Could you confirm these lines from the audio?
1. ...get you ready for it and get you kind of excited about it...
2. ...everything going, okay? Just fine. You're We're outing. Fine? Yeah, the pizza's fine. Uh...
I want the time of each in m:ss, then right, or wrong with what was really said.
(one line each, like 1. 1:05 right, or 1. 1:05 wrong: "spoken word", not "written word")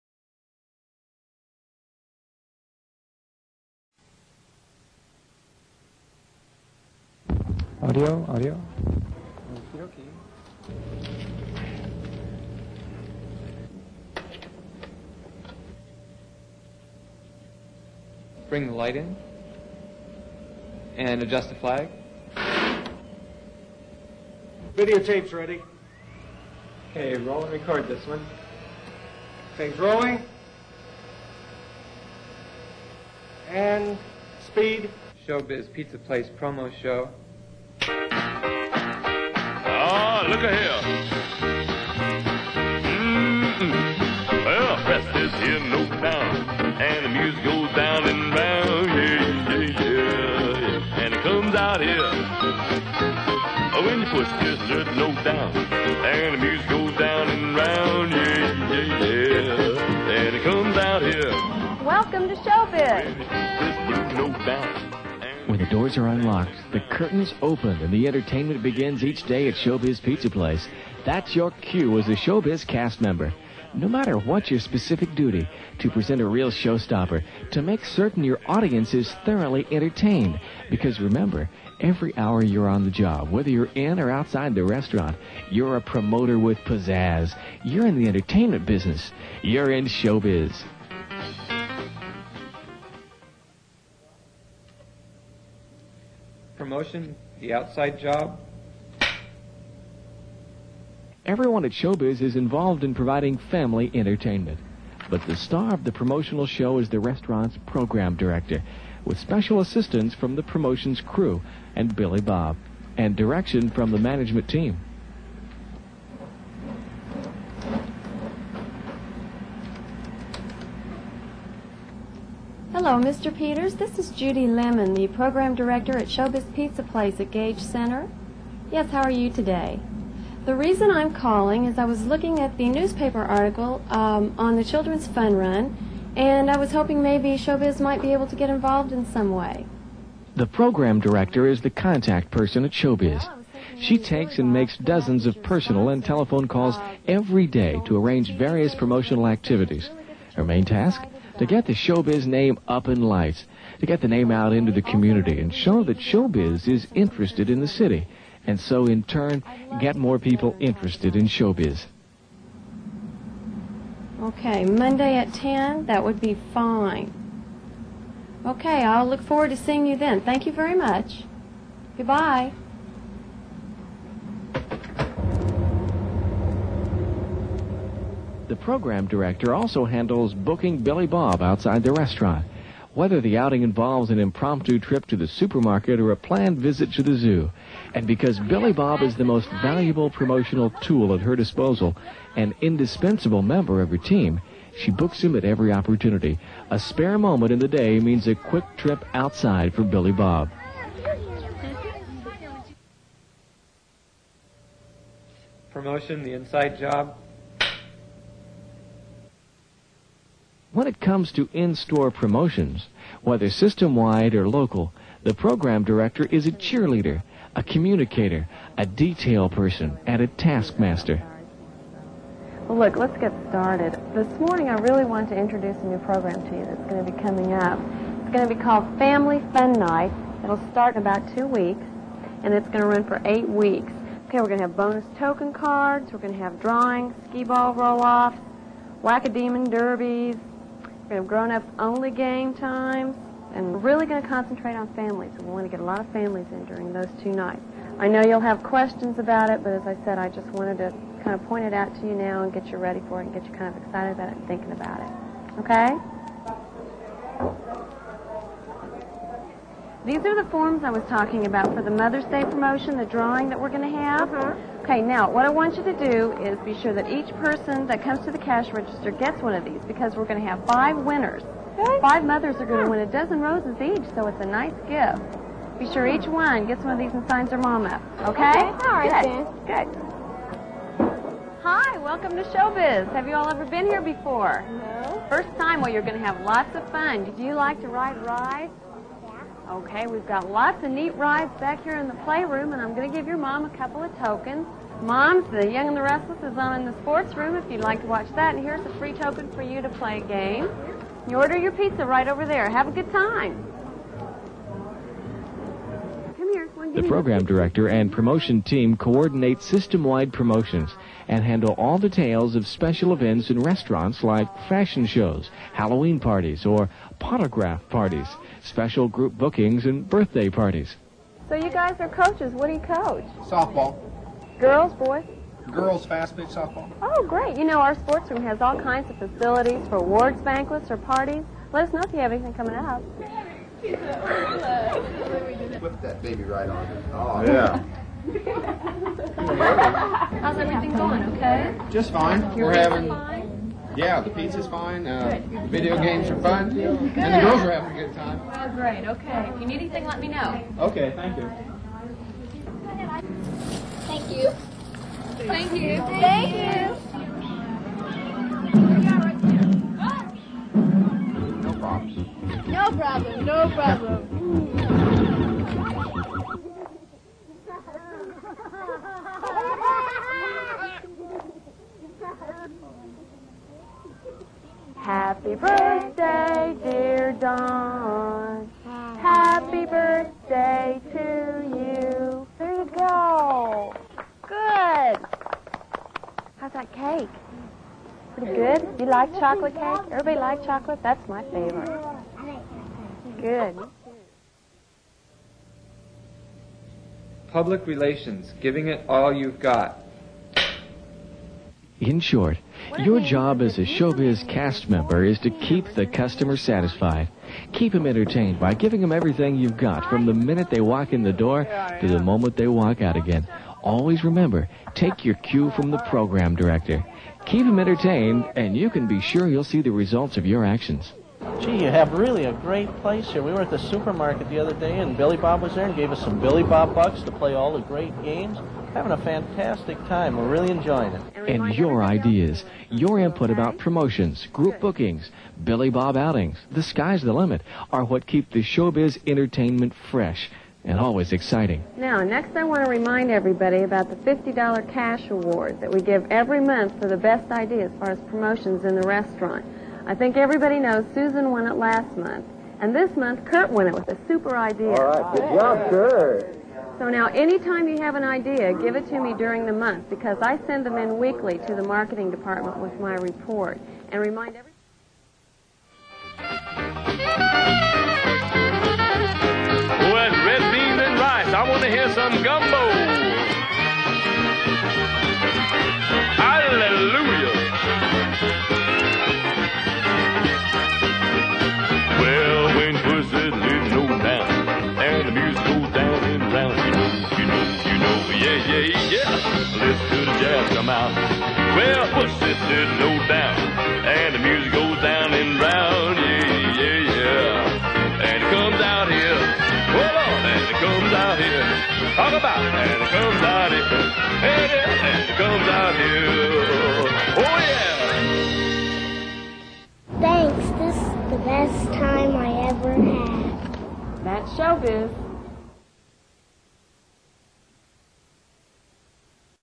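1. 4:12 right
2. 5:40 wrong: "having", not "outing".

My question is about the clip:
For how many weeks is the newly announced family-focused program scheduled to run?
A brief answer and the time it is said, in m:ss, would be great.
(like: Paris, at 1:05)
8, at 3:53.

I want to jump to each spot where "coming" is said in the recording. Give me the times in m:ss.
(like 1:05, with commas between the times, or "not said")
3:47, 5:32.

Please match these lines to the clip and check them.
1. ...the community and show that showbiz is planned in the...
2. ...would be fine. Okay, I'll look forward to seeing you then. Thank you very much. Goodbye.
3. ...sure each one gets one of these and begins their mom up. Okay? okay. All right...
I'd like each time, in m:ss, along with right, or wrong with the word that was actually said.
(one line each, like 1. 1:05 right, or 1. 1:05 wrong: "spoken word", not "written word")
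1. 2:34 wrong: "interested", not "planned"
2. 2:46 right
3. 4:35 wrong: "signs", not "begins".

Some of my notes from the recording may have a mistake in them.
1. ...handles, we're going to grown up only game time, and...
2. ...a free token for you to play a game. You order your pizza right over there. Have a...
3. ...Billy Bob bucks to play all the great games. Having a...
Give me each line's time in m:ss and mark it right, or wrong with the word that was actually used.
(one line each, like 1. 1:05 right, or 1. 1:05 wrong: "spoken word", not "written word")
1. 3:59 wrong: "derbies", not "handles"
2. 4:58 right
3. 7:06 right.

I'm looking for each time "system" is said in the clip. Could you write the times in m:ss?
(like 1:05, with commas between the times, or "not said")
3:33, 5:09.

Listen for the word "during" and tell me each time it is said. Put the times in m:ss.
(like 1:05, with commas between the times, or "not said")
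4:06, 7:39.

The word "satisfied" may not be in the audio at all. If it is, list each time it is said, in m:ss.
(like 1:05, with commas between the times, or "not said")
6:46.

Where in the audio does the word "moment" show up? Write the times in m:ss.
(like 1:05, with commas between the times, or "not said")
3:17, 6:52.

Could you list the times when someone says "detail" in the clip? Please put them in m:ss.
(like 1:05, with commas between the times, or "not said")
3:38, 5:11.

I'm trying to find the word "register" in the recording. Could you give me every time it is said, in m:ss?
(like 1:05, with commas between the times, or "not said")
4:28.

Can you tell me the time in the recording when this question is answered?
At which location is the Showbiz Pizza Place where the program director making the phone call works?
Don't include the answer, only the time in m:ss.
2:07.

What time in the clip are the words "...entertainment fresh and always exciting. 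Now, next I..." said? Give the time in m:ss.
7:19.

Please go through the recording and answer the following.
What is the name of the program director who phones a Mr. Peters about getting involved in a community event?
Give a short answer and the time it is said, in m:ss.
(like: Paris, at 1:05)
Judy Lemon, at 2:04.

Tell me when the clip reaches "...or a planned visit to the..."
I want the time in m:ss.
3:05.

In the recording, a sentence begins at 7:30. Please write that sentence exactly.
I think everybody knows Susan won it last month.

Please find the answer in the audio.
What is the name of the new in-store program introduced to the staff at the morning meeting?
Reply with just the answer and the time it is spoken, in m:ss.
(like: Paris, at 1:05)
Family Fun Night, at 3:48.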